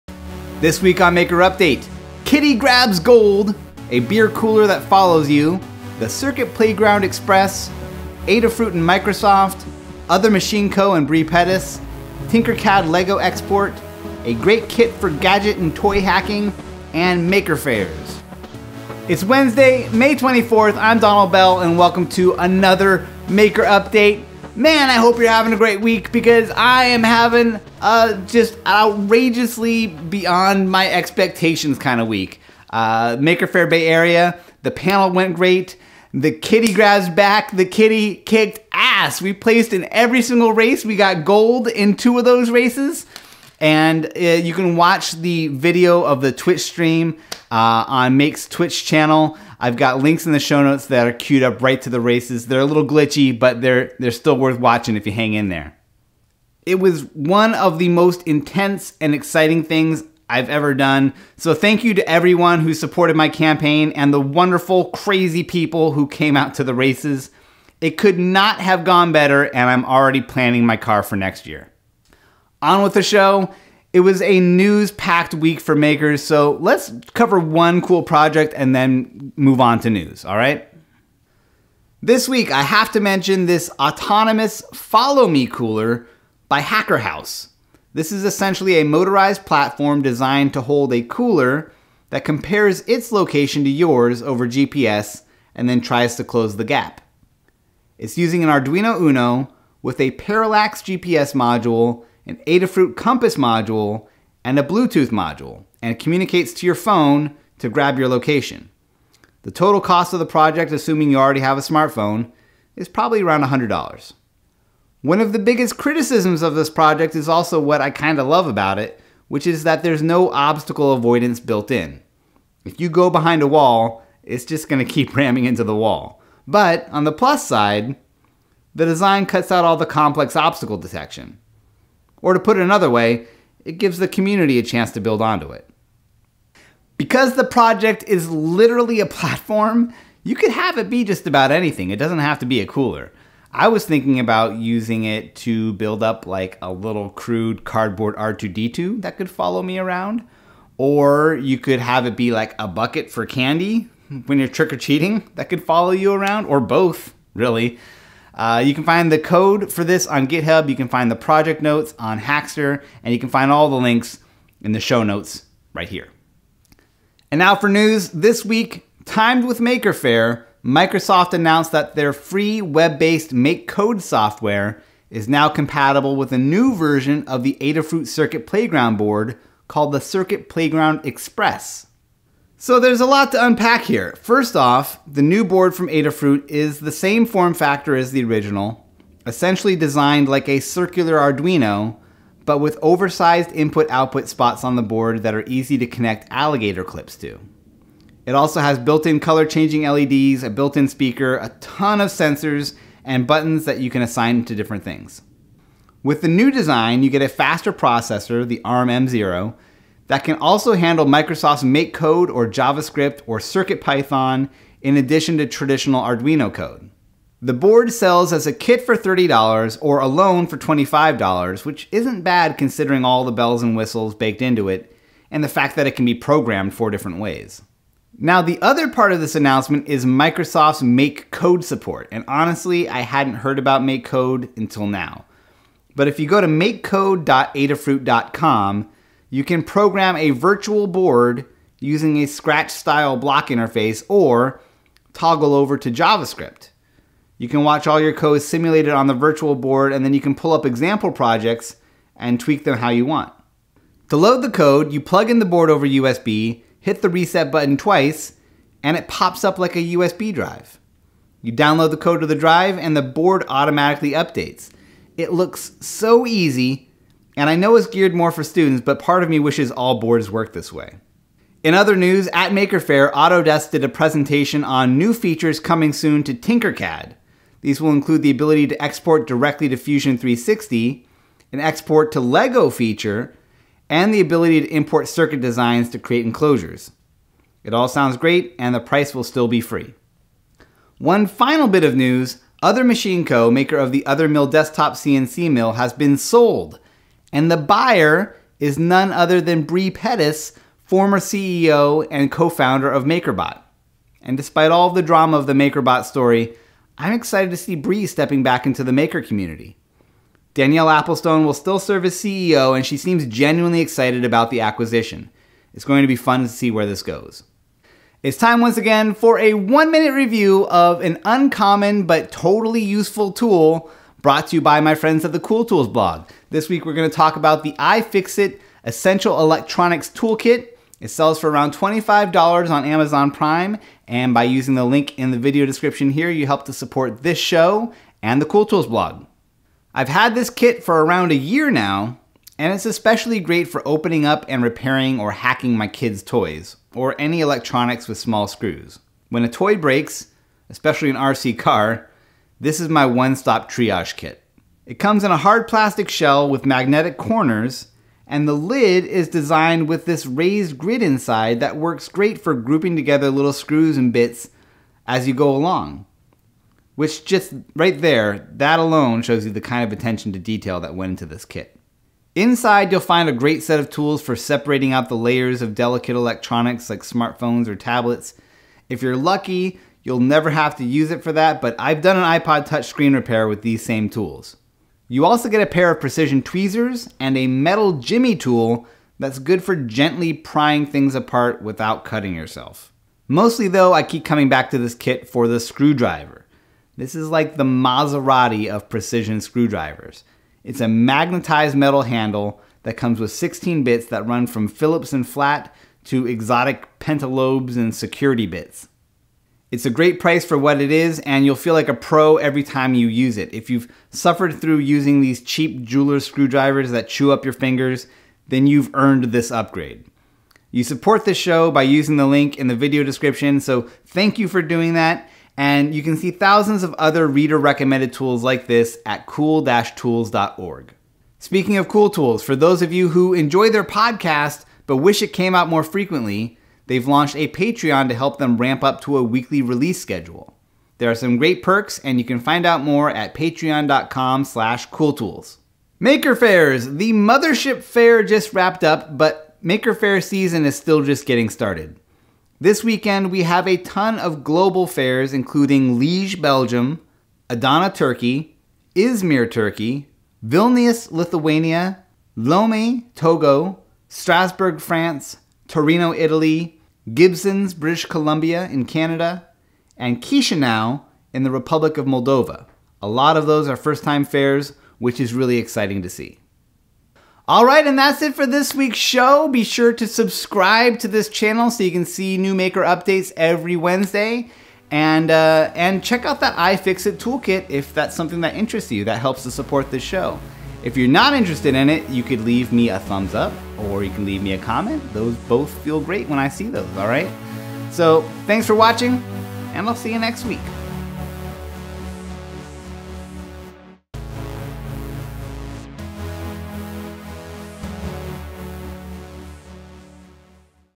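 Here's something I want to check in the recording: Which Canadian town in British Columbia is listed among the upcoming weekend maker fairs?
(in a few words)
Gibsons.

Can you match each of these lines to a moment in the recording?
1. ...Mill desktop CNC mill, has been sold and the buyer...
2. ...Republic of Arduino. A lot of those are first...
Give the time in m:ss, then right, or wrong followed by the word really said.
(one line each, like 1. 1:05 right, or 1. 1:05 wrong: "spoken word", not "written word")
1. 4:54 right
2. 7:51 wrong: "Moldova", not "Arduino".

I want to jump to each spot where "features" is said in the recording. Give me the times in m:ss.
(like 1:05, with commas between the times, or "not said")
4:35, 4:42.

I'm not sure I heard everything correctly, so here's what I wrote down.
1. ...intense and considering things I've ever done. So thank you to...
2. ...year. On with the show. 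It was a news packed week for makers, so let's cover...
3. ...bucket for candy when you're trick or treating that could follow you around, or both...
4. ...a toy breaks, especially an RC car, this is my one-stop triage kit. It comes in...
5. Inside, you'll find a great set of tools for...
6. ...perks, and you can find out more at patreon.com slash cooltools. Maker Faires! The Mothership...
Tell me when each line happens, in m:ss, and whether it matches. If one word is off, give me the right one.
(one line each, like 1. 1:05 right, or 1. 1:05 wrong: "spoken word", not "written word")
1. 0:58 wrong: "exciting", not "considering"
2. 1:11 right
3. 2:32 right
4. 5:49 right
5. 6:12 right
6. 7:21 right.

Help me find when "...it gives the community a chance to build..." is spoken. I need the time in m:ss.
2:13.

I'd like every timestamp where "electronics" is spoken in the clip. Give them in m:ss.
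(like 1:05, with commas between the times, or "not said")
5:29, 5:47, 6:16.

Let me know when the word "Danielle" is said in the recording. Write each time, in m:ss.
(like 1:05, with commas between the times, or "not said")
5:10.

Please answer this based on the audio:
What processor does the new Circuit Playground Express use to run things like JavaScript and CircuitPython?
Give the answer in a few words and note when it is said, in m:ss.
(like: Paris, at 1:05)
ARM M0, at 3:28.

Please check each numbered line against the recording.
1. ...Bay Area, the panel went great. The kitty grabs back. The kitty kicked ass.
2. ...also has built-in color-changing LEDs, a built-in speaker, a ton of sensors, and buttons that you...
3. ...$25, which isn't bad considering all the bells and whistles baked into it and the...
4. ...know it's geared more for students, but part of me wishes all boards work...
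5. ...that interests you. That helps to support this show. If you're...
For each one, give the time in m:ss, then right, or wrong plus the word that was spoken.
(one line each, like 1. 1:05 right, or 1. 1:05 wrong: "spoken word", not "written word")
1. 0:33 right
2. 3:18 right
3. 3:40 right
4. 4:27 right
5. 8:08 right.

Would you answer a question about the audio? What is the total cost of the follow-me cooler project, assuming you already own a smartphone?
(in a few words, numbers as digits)
$100.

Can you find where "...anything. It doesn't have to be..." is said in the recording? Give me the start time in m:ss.
2:21.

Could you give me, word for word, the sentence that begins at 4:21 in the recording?
You download the code to the drive and the board automatically updates.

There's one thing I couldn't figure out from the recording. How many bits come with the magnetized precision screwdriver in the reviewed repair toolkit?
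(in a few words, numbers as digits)
16.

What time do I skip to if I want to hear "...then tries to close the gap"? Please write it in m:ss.
1:35.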